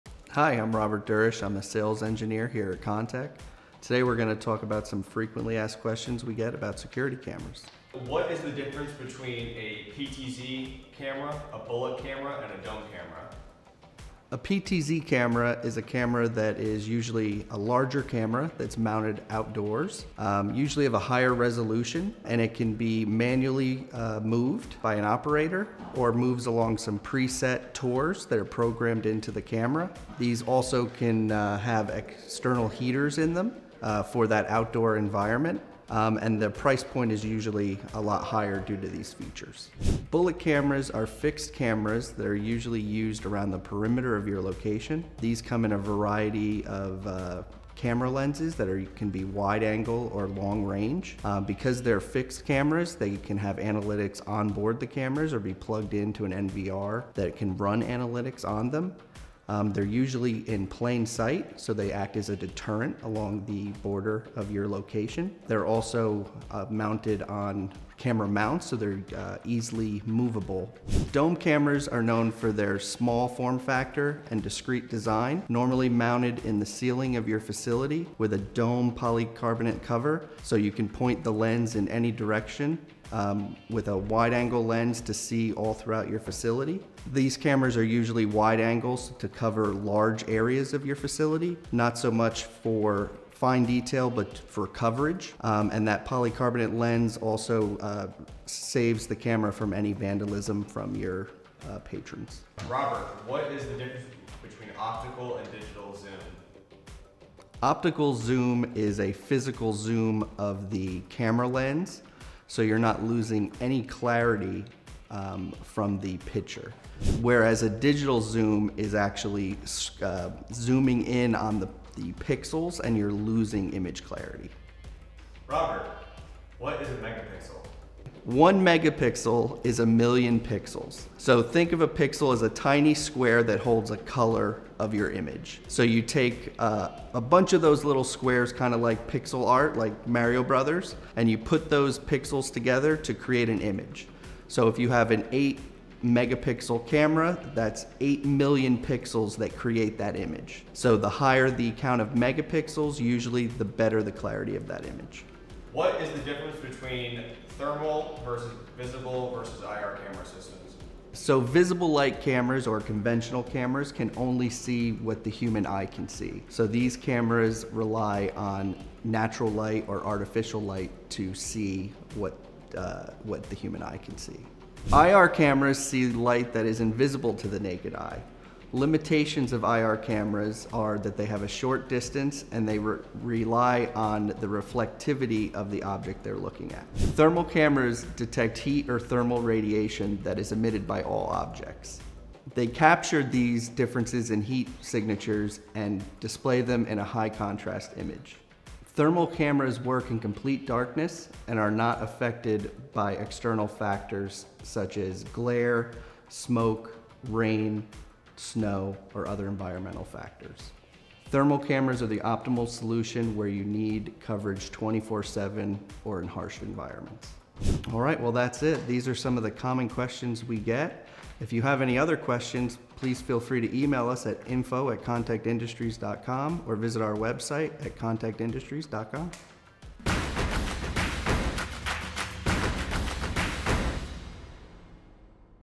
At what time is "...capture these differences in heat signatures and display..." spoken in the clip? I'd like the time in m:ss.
3:12.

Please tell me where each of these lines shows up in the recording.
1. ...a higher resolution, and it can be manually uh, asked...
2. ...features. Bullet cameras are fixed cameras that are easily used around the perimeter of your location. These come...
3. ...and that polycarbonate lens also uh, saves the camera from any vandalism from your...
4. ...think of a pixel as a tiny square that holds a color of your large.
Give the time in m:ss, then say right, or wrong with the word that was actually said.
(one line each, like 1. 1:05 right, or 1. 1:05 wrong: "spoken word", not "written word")
1. 0:20 wrong: "moved", not "asked"
2. 0:39 wrong: "usually", not "easily"
3. 1:35 right
4. 2:11 wrong: "image", not "large".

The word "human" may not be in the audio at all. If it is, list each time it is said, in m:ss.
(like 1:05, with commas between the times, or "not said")
2:45, 2:53.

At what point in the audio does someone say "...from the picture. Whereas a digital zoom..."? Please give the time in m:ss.
1:55.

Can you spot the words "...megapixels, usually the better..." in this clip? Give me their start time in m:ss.
2:32.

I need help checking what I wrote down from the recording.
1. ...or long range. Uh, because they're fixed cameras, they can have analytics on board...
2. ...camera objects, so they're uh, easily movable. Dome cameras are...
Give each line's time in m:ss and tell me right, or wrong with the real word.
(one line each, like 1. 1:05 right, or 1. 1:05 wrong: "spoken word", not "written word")
1. 0:50 right
2. 1:08 wrong: "mounts", not "objects".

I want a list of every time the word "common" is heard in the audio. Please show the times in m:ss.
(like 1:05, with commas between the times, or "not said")
3:39.